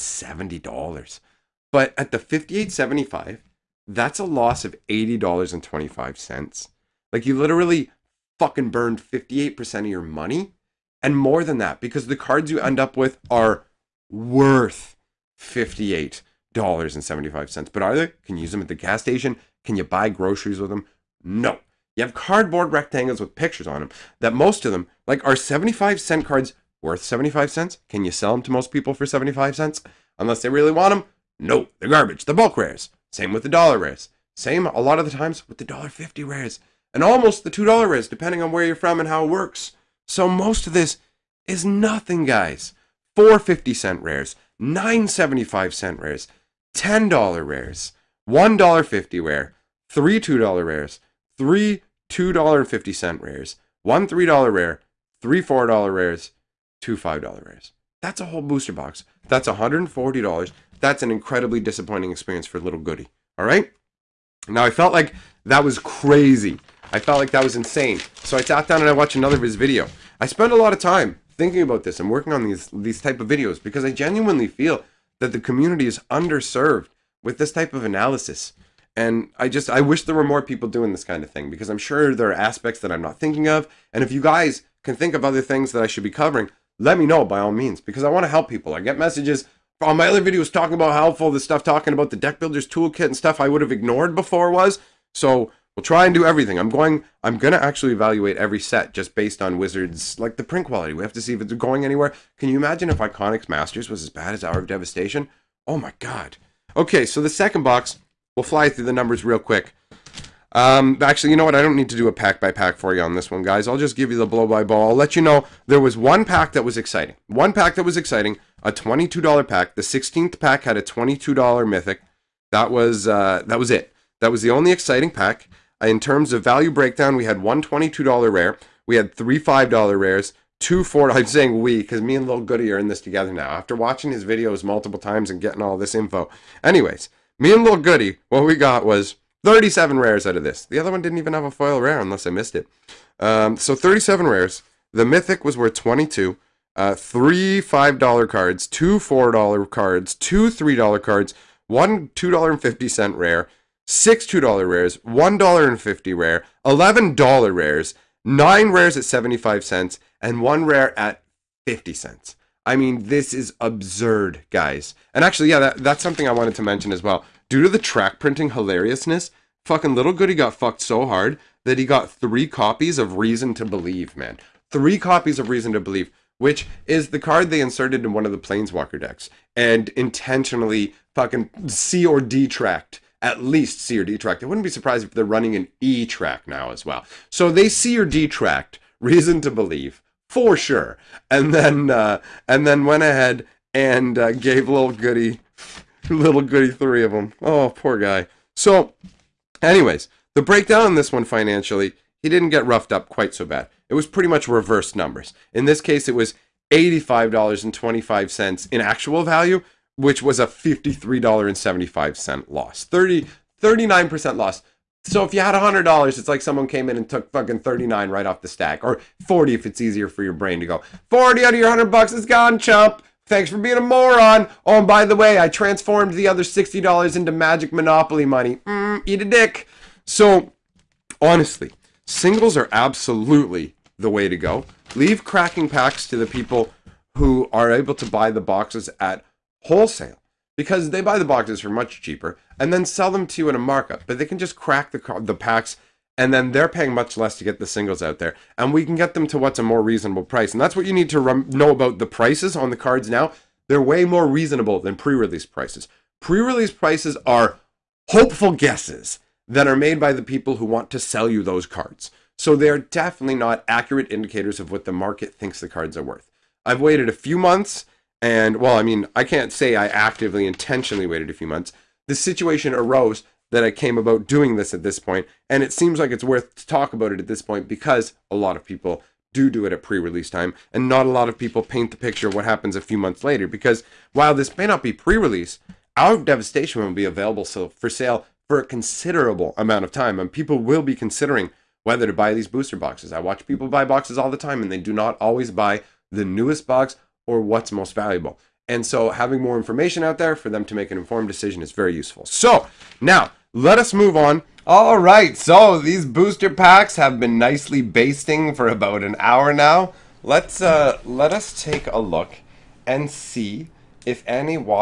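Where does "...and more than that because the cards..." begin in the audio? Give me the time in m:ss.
0:11.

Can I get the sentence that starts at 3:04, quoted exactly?
I wouldn't be surprised if they're running an E track now as well.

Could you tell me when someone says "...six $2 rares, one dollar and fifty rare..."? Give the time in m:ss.
2:33.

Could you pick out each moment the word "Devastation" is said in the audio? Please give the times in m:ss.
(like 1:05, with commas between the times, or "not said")
1:44, 4:46.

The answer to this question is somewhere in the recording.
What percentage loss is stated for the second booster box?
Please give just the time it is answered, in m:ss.
3:33.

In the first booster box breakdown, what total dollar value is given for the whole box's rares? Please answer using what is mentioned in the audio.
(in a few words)
$140.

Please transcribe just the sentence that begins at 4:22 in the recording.
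So they're definitely not accurate indicators of what the market thinks the cards are worth.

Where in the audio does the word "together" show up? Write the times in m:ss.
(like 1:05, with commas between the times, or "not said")
2:12.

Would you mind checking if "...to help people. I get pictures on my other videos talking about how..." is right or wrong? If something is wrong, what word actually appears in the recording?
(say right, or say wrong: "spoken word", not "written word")
wrong: "messages", not "pictures".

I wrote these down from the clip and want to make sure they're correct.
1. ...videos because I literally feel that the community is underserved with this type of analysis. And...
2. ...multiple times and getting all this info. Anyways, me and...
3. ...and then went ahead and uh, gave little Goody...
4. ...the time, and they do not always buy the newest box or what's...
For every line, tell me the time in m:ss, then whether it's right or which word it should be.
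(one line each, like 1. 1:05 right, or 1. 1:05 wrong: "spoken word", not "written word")
1. 1:13 wrong: "genuinely", not "literally"
2. 2:14 right
3. 3:12 right
4. 4:54 right.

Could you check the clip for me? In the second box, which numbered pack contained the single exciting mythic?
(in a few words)
16th.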